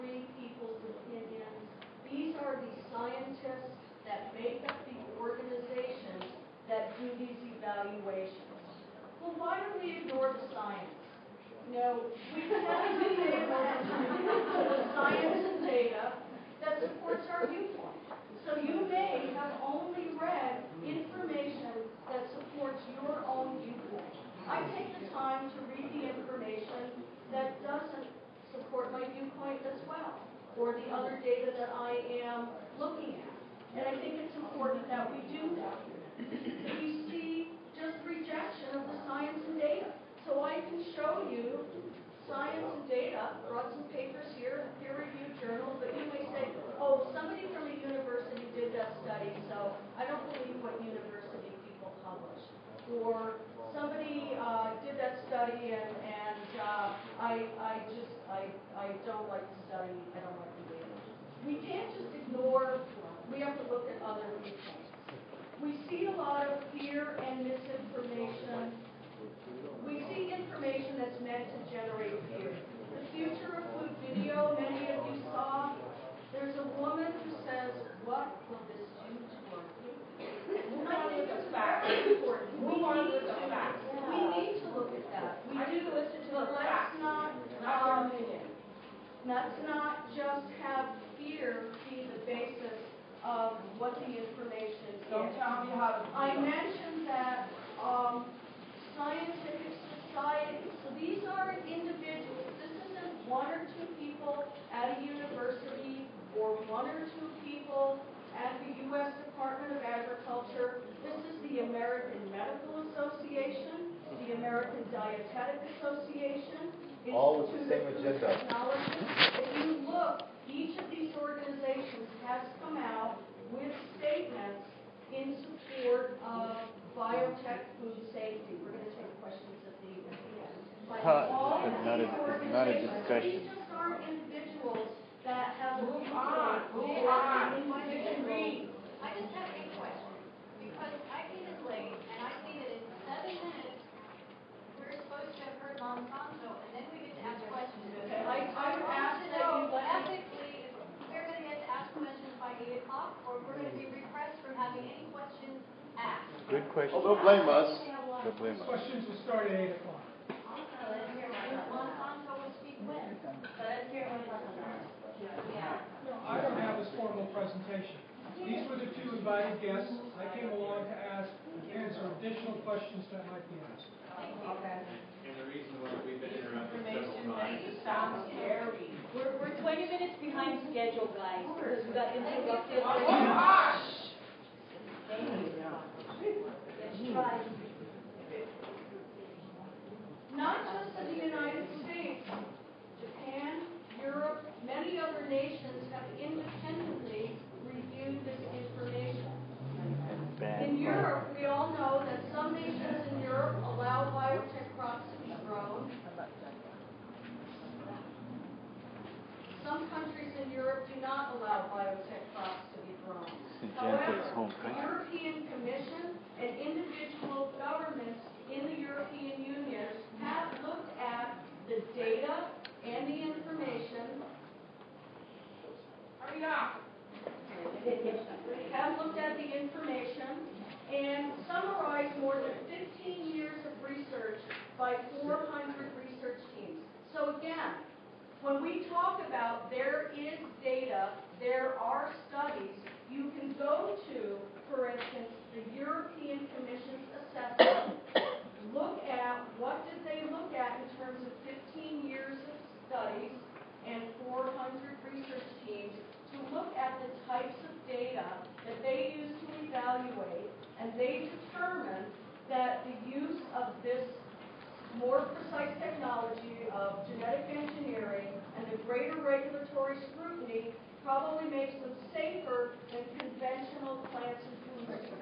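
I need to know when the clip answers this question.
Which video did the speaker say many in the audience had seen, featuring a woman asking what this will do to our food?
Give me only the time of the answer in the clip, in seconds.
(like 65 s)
73 s.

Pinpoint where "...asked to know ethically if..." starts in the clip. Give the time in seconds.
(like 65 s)
148 s.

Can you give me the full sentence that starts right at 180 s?
behind schedule, guys, because we got interrupted.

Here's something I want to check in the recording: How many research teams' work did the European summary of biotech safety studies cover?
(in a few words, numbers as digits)
400.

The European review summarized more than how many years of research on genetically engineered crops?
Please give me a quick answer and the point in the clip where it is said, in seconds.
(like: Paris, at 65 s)
15 years, at 233 s.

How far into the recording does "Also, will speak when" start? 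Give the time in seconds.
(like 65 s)
160 s.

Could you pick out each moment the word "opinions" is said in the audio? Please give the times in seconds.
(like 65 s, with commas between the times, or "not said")
0 s.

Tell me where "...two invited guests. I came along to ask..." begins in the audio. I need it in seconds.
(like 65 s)
168 s.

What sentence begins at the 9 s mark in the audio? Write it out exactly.
Well, why do we ignore the science?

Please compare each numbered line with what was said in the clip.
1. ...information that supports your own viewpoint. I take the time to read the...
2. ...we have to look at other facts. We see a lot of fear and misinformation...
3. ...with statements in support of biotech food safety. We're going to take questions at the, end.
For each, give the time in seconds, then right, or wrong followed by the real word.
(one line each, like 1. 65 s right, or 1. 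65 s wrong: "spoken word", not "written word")
1. 20 s right
2. 63 s wrong: "viewpoints", not "facts"
3. 123 s right.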